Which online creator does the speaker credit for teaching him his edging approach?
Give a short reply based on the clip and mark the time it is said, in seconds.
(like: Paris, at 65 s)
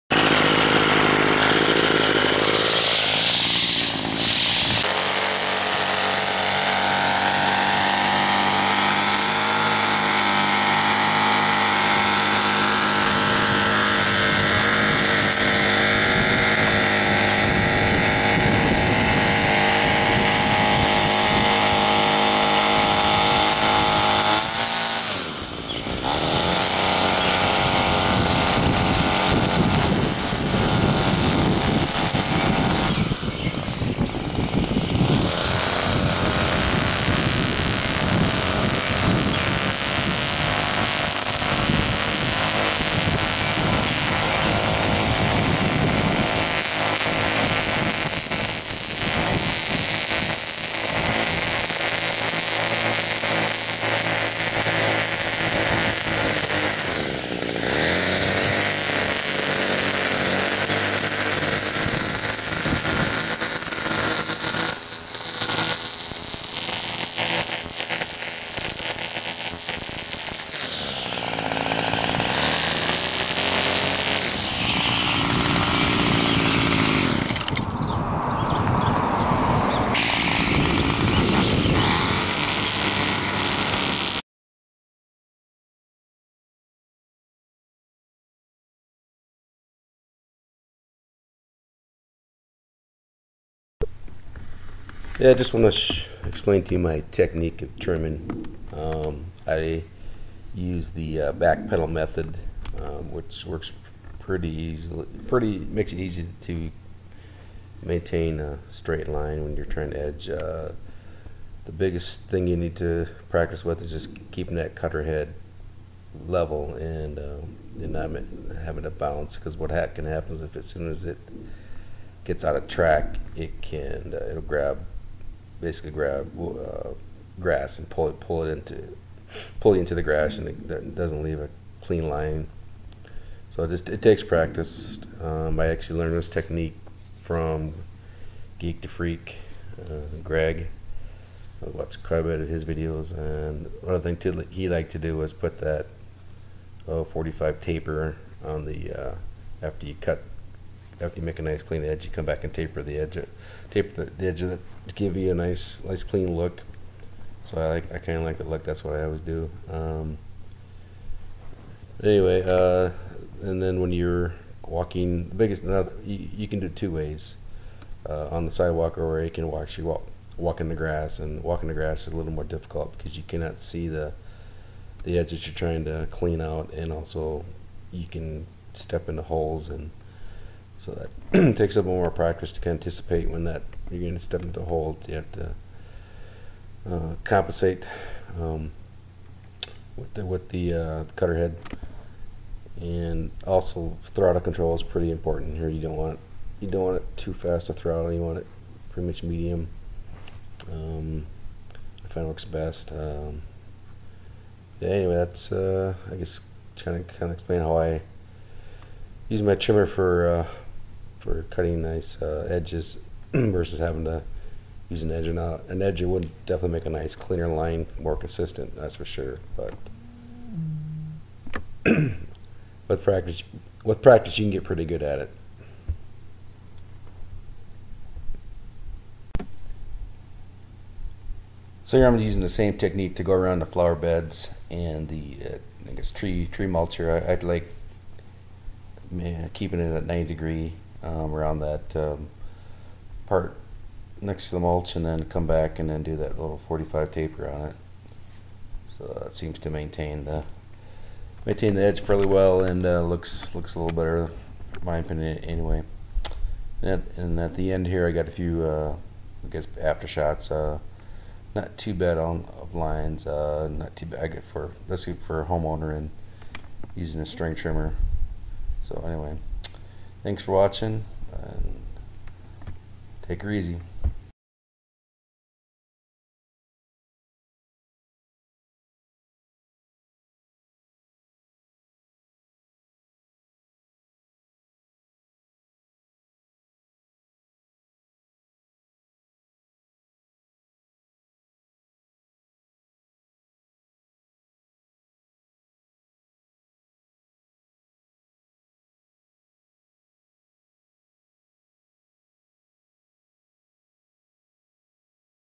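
Geek to Freak, at 138 s.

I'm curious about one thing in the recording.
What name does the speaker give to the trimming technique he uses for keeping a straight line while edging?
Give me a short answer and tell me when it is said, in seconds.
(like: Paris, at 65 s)
Back pedal method, at 101 s.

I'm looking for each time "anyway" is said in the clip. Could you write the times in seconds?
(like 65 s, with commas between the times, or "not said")
162 s, 204 s, 255 s, 269 s.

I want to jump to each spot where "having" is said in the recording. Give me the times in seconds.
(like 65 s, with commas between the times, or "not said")
118 s, 213 s.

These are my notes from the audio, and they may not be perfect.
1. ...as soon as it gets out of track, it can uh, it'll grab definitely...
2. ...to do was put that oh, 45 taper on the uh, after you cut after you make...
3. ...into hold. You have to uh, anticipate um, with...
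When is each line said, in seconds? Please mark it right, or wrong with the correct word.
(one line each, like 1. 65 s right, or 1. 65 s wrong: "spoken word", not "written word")
1. 120 s wrong: "basically", not "definitely"
2. 144 s right
3. 184 s wrong: "compensate", not "anticipate".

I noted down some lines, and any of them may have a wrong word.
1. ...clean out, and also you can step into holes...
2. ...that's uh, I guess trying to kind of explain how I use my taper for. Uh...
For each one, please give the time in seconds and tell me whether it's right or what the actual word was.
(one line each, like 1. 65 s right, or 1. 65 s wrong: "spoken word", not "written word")
1. 176 s right
2. 205 s wrong: "trimmer", not "taper".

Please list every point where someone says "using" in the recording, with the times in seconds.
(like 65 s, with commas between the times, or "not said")
232 s, 266 s.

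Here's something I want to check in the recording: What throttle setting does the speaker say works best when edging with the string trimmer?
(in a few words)
Medium.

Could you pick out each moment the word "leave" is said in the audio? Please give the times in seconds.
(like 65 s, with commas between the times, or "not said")
131 s.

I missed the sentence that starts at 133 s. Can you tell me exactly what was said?
So it just it takes practice.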